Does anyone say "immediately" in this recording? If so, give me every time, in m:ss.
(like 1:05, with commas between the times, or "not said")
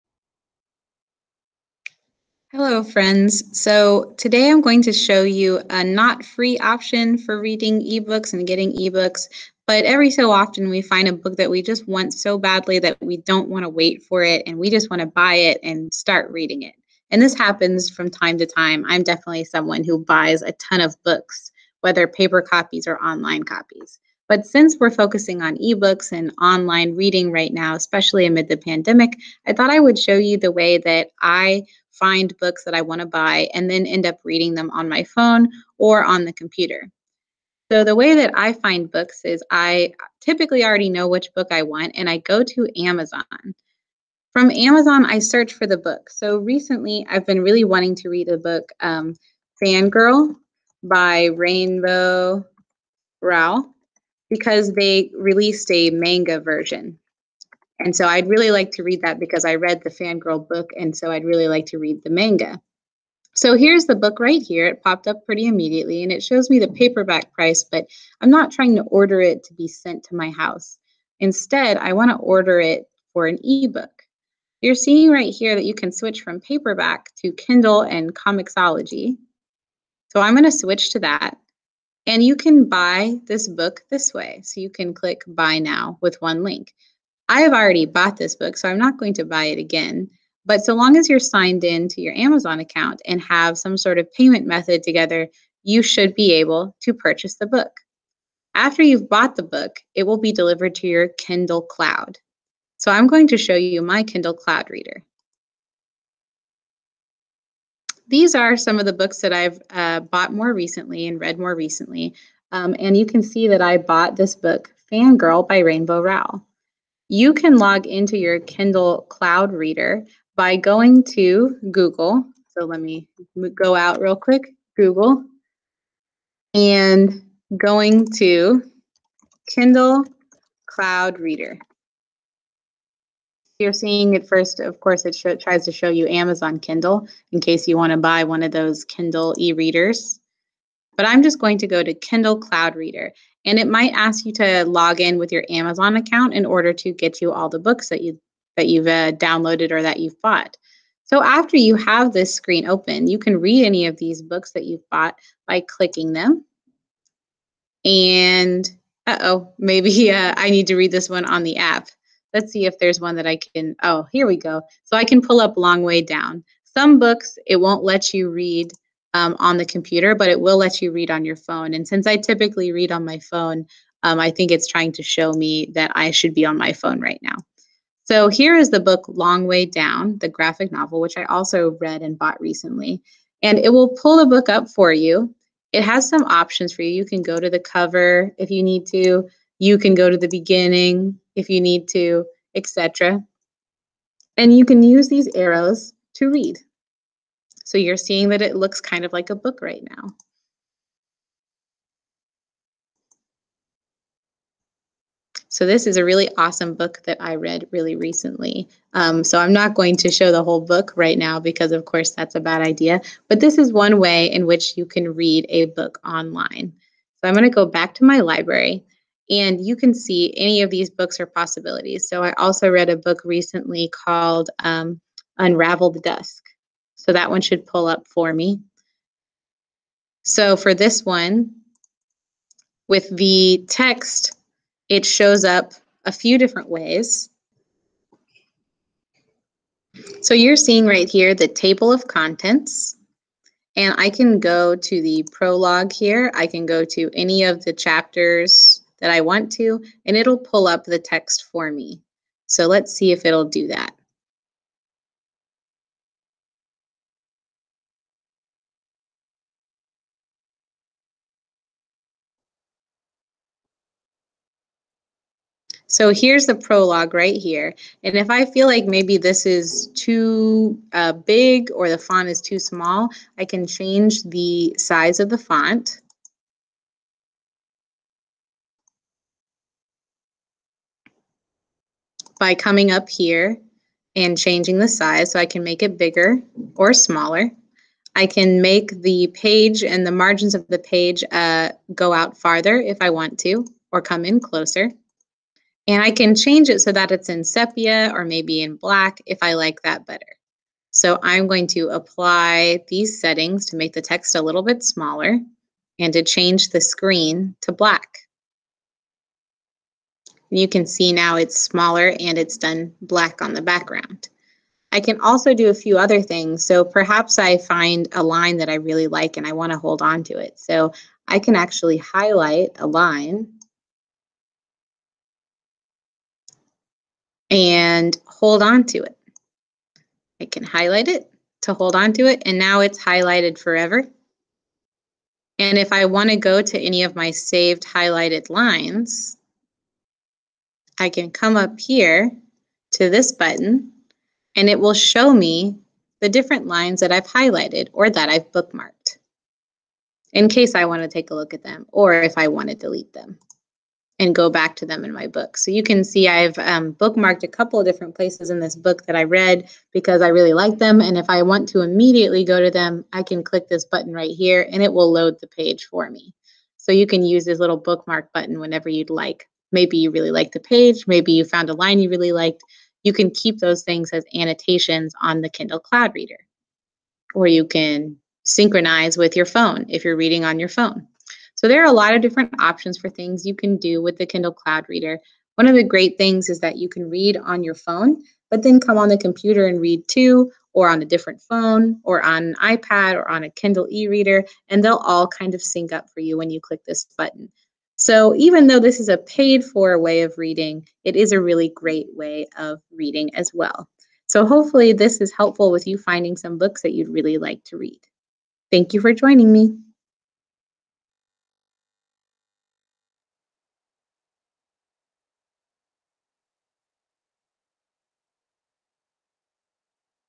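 1:05, 6:01.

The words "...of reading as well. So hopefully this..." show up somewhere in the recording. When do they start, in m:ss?
6:42.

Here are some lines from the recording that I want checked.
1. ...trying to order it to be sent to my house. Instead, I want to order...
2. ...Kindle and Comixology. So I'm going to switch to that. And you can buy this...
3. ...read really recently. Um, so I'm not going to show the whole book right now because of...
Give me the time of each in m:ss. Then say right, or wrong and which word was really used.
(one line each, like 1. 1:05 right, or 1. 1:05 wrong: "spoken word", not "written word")
1. 1:08 right
2. 1:17 right
3. 3:27 right.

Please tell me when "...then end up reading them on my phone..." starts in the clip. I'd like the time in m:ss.
0:33.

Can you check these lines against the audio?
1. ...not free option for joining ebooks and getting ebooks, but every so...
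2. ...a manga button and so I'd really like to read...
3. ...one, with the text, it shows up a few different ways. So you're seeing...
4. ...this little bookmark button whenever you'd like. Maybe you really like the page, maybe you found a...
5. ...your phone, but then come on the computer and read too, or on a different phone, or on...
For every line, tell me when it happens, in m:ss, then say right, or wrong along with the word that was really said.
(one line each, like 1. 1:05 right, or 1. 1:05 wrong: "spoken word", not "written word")
1. 0:05 wrong: "reading", not "joining"
2. 0:55 wrong: "version", not "button"
3. 3:51 right
4. 6:07 right
5. 6:27 right.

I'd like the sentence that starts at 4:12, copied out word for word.
So let's see if it'll do that.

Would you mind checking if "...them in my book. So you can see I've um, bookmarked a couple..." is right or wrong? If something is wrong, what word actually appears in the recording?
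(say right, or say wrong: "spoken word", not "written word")
right.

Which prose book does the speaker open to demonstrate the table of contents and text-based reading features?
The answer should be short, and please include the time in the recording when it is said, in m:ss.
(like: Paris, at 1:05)
Unravel the Dusk, at 3:45.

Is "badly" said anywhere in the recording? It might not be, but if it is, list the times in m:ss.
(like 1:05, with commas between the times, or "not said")
0:12.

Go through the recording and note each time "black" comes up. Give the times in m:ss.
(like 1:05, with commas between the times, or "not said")
4:58, 5:07, 5:13.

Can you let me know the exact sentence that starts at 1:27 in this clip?
I have already bought this book, so I'm not going to buy it again.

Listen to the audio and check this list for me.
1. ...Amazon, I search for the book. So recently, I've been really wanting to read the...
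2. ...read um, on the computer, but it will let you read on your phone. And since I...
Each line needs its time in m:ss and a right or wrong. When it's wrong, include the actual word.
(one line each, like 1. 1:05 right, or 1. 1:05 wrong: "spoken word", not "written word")
1. 0:44 right
2. 2:48 right.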